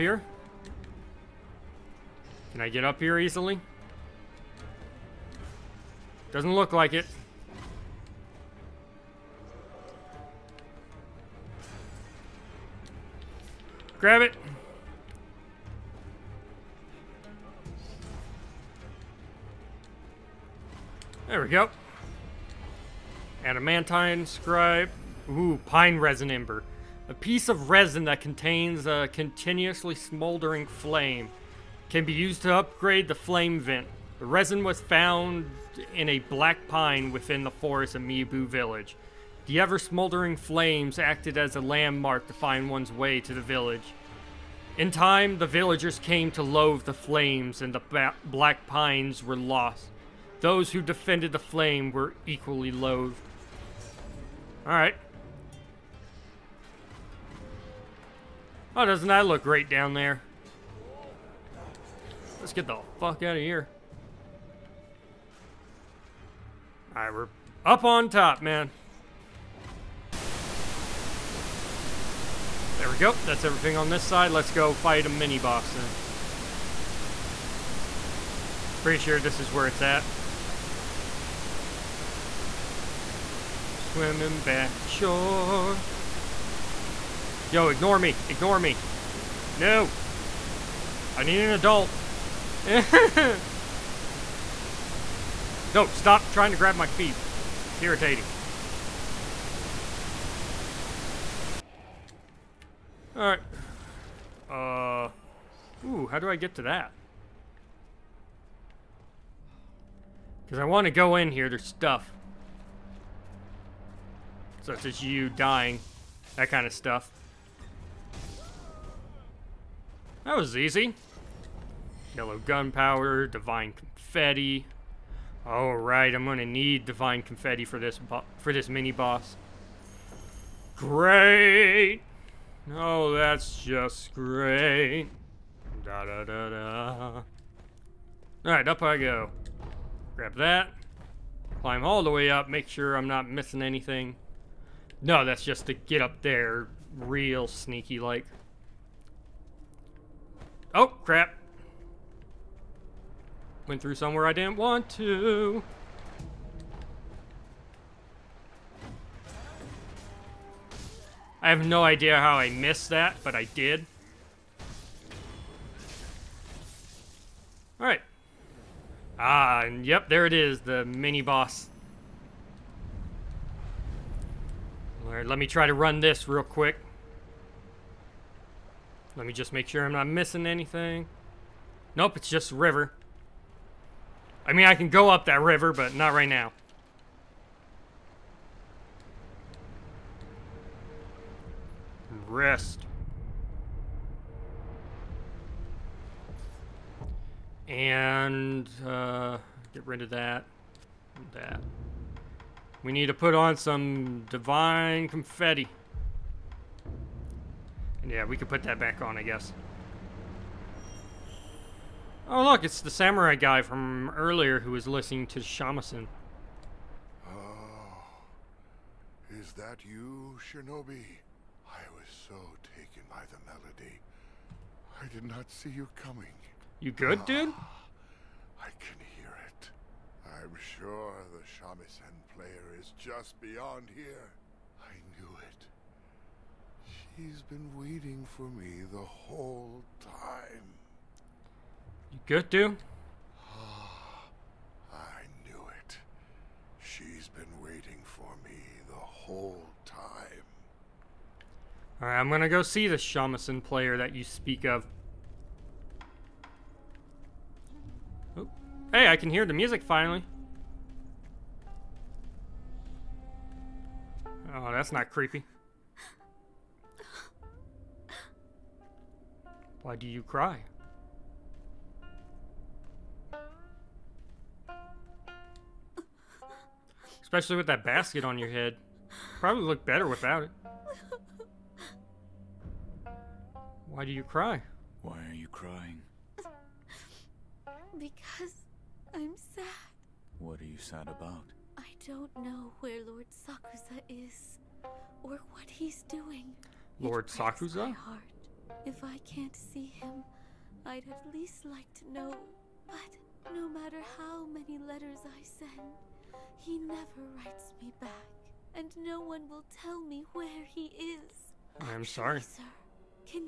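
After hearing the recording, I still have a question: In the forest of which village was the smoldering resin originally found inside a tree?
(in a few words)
Mibu village.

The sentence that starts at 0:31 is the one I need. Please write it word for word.
Can be used to upgrade the flame vent.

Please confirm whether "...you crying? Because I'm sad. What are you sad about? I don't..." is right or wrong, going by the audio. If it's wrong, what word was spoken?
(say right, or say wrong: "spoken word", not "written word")
right.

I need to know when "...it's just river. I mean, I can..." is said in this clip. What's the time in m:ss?
3:02.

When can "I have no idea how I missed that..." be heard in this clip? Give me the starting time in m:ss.
2:41.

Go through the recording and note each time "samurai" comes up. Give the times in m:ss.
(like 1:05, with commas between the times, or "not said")
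3:32.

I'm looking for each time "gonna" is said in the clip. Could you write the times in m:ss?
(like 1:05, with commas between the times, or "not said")
2:06, 4:12.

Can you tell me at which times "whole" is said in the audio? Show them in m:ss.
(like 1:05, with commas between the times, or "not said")
3:58, 4:08.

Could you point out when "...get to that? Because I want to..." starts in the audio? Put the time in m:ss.
1:46.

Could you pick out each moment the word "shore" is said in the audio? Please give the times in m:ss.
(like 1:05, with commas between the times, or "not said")
1:24.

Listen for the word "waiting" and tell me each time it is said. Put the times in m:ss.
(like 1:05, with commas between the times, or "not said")
3:57, 4:07.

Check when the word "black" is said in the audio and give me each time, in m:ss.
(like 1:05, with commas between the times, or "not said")
0:36, 0:48.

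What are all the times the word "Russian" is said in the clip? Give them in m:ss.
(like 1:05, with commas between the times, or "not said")
not said.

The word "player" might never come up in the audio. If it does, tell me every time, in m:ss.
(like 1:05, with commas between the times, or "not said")
3:52, 4:13.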